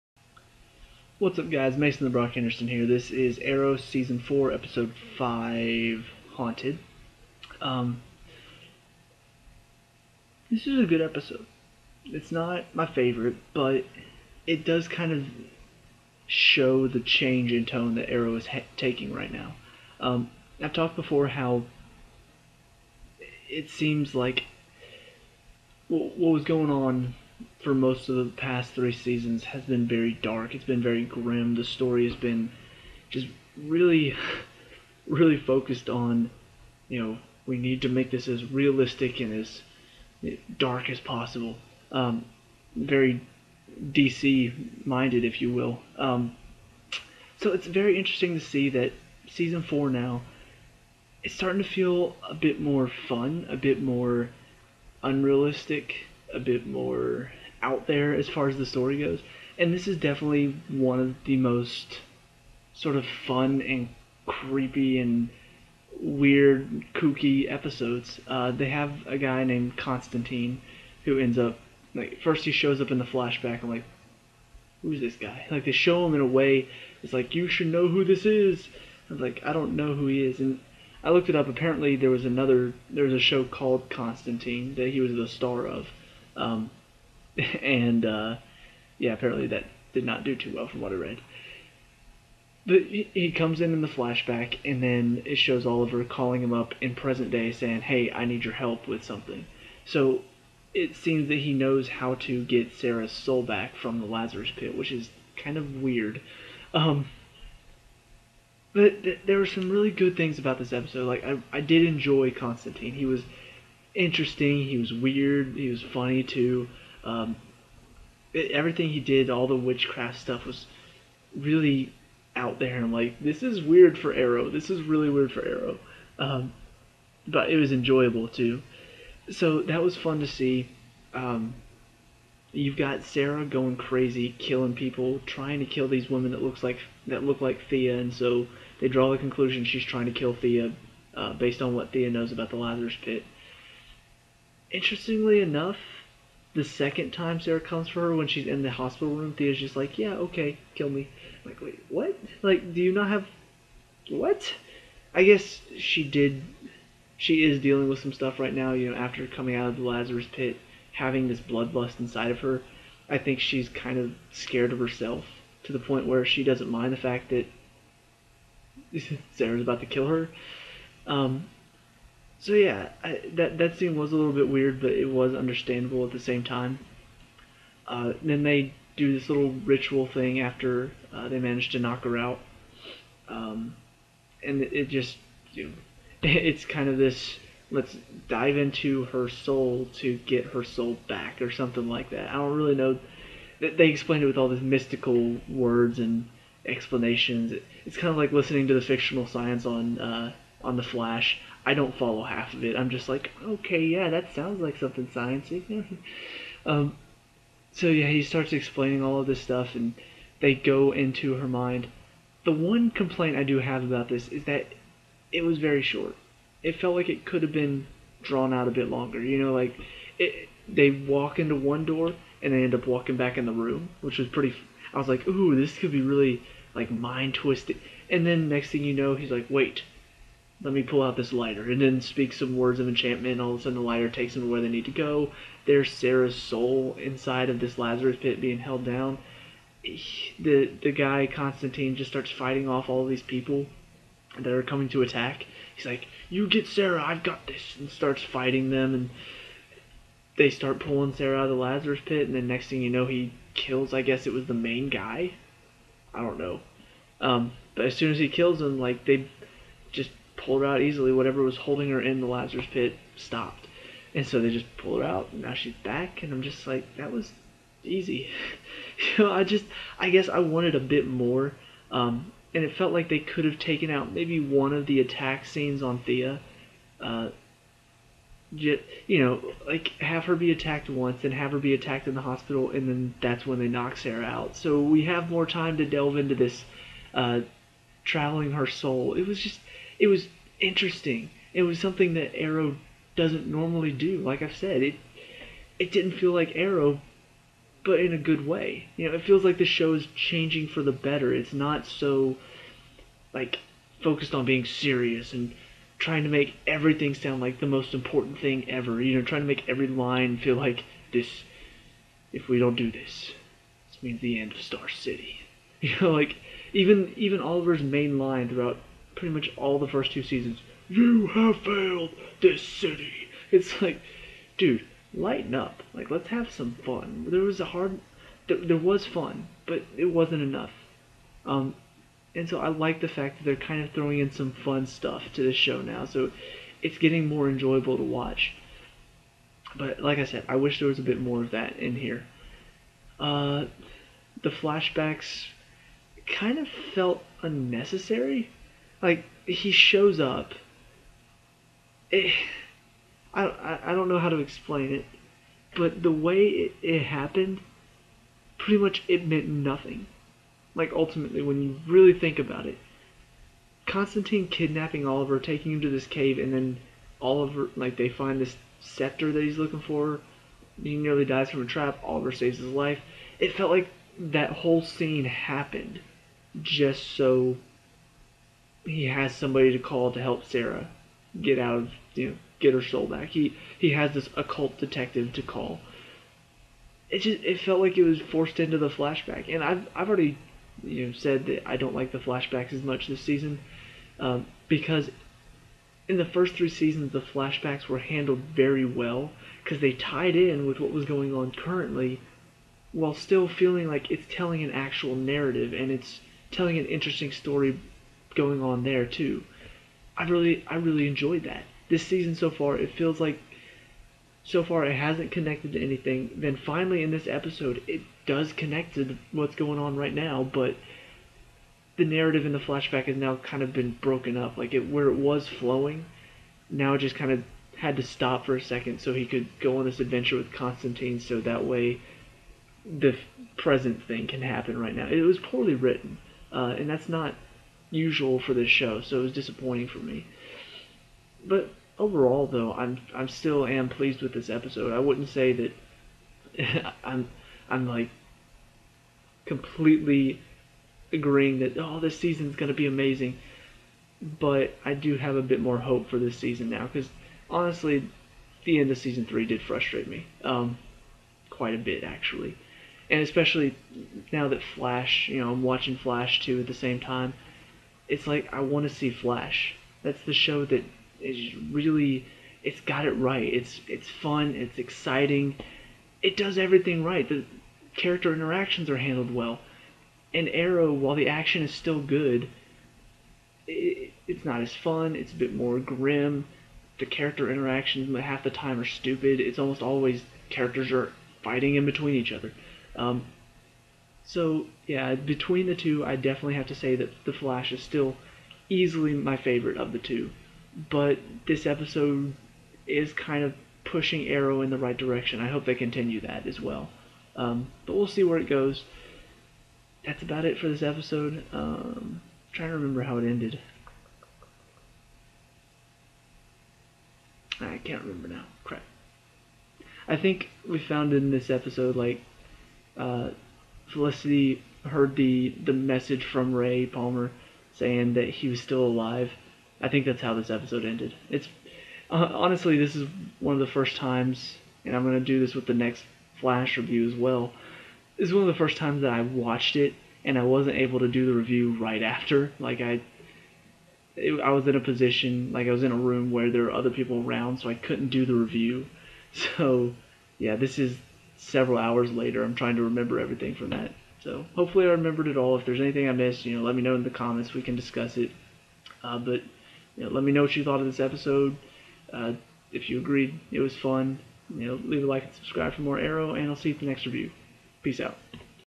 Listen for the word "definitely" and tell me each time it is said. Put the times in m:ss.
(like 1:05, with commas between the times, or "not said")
0:59, 8:16.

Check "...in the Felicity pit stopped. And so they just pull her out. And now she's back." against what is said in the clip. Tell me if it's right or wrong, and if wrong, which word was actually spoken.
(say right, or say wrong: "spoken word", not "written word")
wrong: "Lazarus", not "Felicity".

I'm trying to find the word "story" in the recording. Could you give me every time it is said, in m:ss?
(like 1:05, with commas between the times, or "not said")
0:31, 0:58, 6:47.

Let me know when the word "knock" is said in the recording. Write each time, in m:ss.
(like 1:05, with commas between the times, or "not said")
3:01, 4:43.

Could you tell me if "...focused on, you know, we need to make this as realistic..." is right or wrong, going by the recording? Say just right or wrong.
right.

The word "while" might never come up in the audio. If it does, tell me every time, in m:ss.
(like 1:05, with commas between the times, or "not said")
6:42, 8:00.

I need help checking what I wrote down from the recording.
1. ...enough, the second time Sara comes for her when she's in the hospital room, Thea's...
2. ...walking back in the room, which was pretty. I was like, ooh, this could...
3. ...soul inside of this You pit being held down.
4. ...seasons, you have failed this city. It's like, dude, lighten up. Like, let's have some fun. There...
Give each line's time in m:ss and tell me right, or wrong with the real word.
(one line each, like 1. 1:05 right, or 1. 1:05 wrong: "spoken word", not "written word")
1. 2:25 right
2. 3:42 right
3. 3:56 wrong: "Lazarus", not "You"
4. 5:20 right.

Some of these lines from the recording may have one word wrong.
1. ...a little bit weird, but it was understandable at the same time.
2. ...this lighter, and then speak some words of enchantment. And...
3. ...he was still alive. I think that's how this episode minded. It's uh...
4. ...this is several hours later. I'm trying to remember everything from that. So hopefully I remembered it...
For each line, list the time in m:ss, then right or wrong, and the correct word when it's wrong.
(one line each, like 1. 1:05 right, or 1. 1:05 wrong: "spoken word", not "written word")
1. 2:54 right
2. 3:51 right
3. 8:48 wrong: "ended", not "minded"
4. 9:10 right.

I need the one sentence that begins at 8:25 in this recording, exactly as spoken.
I hope they continue that as well.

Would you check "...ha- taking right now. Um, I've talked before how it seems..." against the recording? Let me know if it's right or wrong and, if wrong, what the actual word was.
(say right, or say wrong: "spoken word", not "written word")
right.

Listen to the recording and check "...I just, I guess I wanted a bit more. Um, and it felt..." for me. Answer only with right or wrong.
right.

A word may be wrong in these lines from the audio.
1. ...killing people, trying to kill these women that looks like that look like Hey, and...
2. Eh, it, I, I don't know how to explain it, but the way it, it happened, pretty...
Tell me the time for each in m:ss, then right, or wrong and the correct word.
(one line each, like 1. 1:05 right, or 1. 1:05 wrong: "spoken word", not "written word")
1. 2:14 wrong: "Thea", not "Hey"
2. 5:52 right.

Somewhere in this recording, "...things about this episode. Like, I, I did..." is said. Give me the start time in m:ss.
1:50.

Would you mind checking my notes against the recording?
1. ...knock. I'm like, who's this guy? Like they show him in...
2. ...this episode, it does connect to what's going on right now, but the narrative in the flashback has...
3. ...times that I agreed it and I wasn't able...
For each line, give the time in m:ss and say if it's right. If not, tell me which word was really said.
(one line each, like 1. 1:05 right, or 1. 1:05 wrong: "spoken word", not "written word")
1. 1:13 wrong: "flashback", not "knock"
2. 6:57 right
3. 8:58 wrong: "watched", not "agreed".